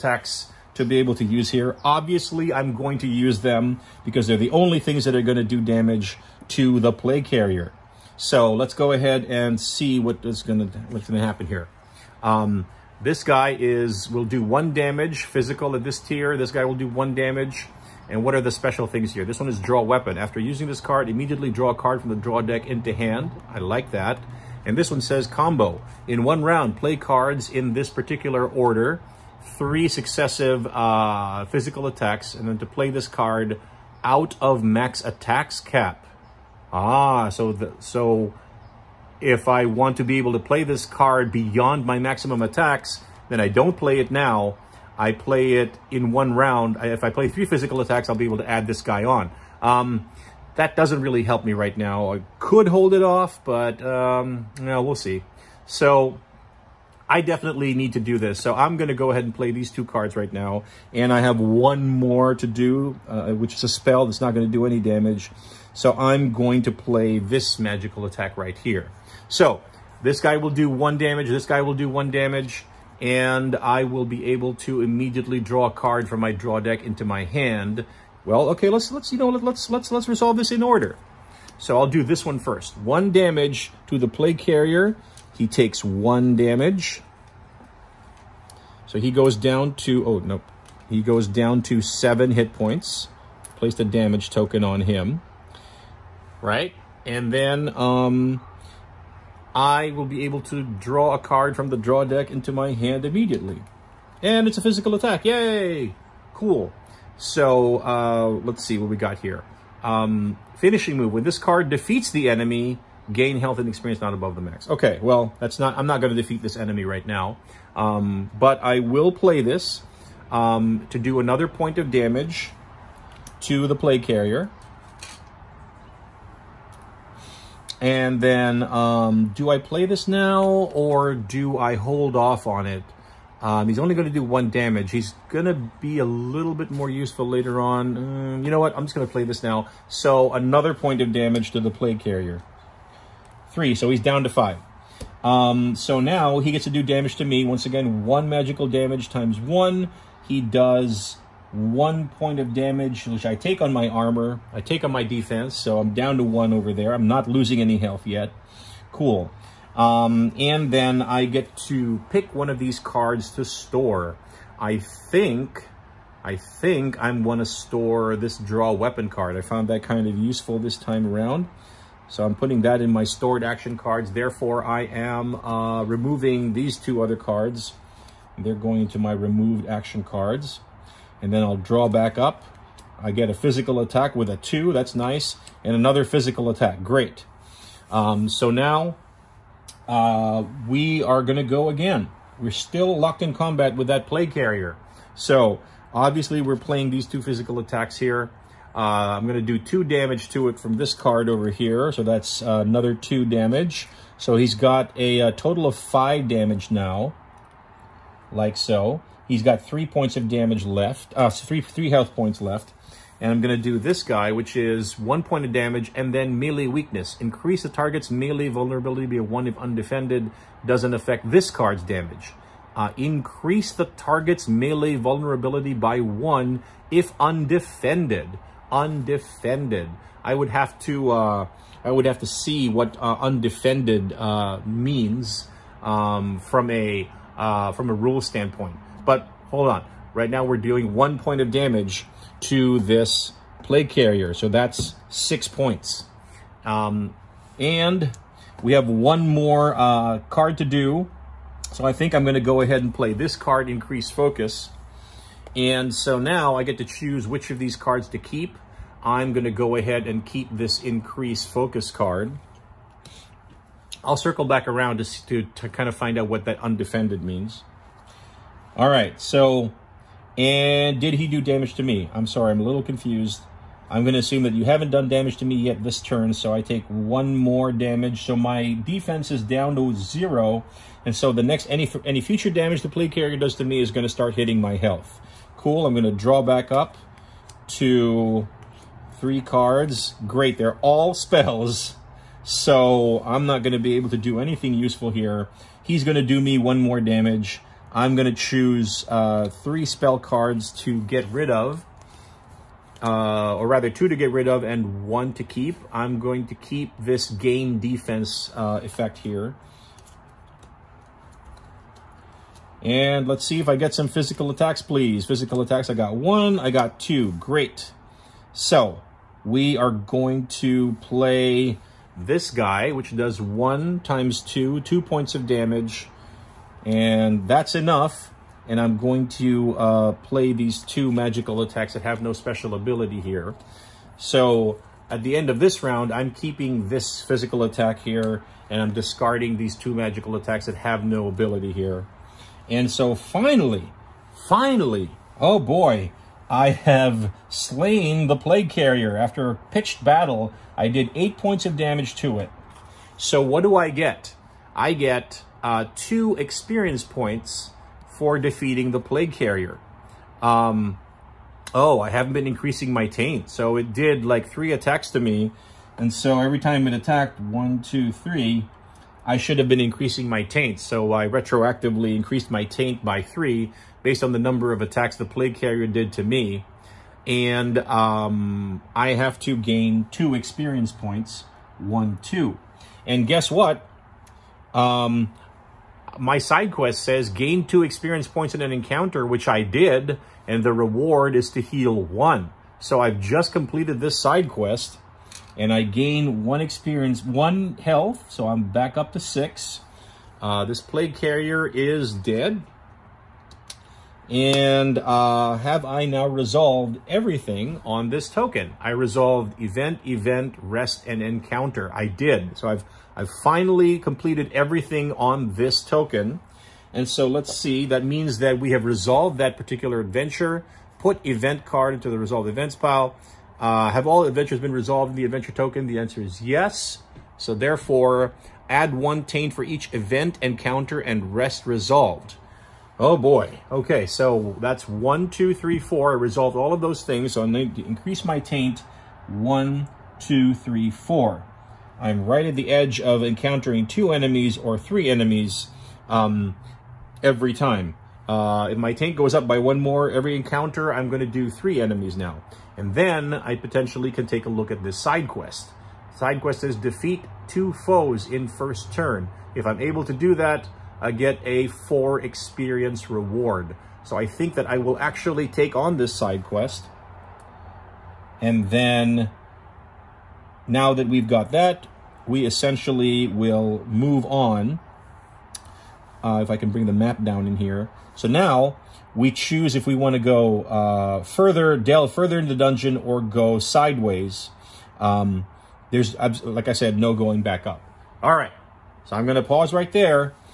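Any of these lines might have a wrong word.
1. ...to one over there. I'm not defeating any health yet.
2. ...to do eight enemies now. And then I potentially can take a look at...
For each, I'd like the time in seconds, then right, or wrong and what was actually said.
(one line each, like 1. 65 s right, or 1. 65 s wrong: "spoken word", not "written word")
1. 156 s wrong: "losing", not "defeating"
2. 451 s wrong: "three", not "eight".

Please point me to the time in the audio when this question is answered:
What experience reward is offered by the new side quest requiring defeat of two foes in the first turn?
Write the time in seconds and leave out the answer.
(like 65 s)
461 s.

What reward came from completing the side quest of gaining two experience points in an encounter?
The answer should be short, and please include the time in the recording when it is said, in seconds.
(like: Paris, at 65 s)
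heal one, at 391 s.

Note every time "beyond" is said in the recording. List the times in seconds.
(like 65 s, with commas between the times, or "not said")
41 s.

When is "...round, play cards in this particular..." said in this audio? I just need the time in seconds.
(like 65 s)
26 s.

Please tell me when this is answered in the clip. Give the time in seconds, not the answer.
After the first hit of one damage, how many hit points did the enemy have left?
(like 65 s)
91 s.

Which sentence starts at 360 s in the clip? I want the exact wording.
Um, oh, I haven't been increasing my taint.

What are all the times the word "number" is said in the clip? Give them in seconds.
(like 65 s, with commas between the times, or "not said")
374 s.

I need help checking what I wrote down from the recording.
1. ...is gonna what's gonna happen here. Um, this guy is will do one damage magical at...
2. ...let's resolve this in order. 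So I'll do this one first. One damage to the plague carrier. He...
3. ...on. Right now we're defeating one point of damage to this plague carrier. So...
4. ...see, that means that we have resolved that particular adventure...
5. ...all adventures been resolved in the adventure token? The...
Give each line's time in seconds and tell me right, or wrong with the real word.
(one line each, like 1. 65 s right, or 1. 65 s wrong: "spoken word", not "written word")
1. 10 s wrong: "physical", not "magical"
2. 79 s right
3. 239 s wrong: "dealing", not "defeating"
4. 417 s right
5. 424 s right.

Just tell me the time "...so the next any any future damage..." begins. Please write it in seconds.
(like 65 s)
281 s.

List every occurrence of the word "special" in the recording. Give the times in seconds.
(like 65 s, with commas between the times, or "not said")
18 s, 332 s.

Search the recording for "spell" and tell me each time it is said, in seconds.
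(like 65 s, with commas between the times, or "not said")
63 s, 291 s, 299 s.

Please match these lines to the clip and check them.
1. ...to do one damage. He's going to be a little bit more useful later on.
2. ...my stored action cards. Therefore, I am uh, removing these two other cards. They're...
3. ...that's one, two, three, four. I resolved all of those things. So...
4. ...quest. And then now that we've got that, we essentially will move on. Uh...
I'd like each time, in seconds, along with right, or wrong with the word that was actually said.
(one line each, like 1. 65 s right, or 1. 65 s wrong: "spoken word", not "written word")
1. 134 s right
2. 172 s right
3. 434 s right
4. 466 s right.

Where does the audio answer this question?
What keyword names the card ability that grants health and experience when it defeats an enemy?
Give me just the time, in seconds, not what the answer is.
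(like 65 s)
110 s.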